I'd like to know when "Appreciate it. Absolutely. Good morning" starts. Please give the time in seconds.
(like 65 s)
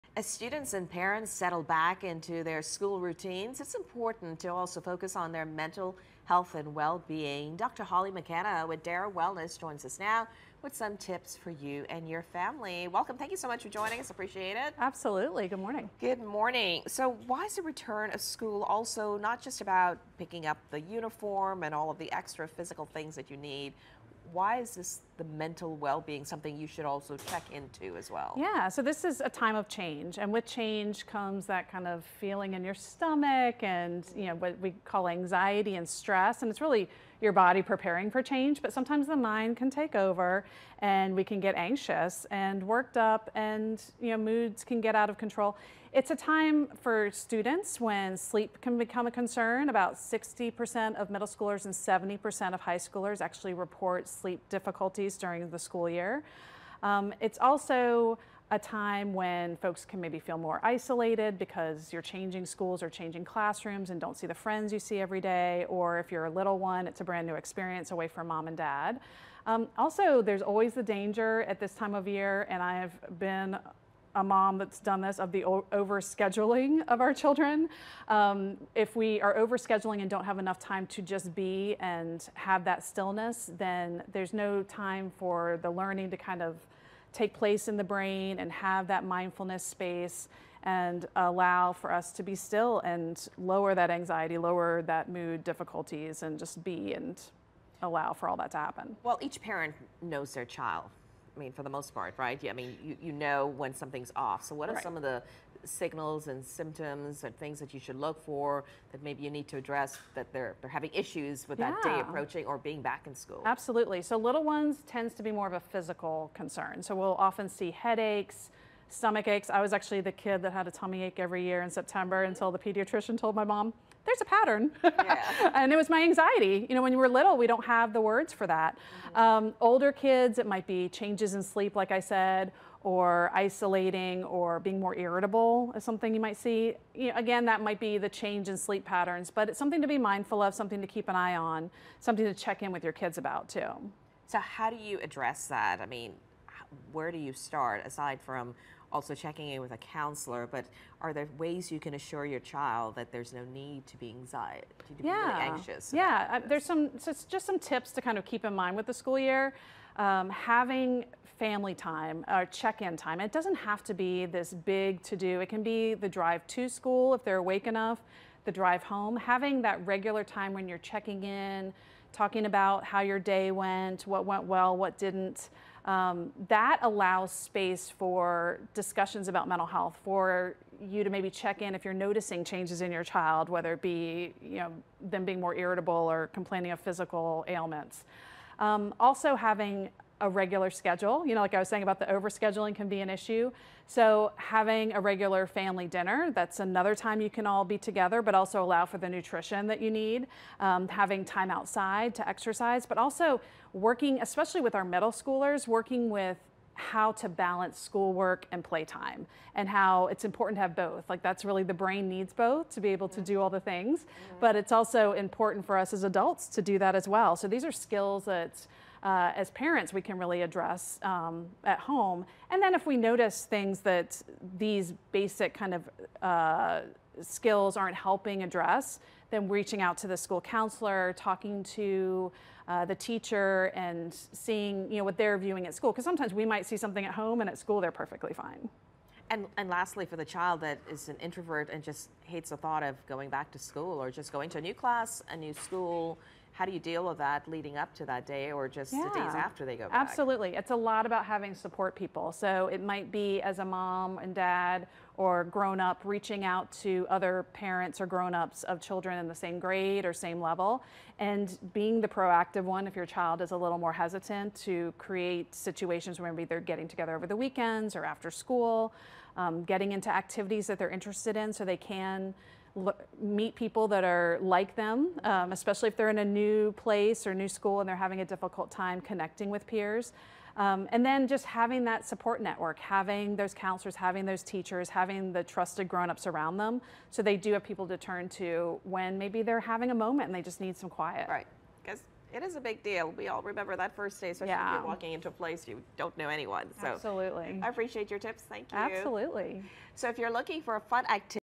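14 s.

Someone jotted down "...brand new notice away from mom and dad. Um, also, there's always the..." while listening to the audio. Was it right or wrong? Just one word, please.
wrong.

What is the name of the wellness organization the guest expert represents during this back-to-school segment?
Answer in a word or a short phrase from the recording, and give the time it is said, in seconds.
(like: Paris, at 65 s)
Dara Wellness, at 8 s.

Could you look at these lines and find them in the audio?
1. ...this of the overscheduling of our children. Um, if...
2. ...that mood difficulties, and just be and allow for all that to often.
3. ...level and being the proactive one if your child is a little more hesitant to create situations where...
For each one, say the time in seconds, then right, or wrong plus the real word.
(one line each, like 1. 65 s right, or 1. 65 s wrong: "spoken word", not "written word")
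1. 75 s right
2. 94 s wrong: "happen", not "often"
3. 260 s right.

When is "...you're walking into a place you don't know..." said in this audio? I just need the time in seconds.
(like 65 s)
294 s.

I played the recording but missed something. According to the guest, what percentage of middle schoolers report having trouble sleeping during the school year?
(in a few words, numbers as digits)
60%.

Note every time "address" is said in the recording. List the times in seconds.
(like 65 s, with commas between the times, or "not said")
109 s, 145 s, 220 s, 228 s.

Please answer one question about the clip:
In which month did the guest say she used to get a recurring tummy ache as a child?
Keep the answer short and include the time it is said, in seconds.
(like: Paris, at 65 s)
September, at 121 s.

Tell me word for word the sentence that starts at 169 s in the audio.
Having that regular time when you're checking in, talking about how your day went, what went well, what didn't.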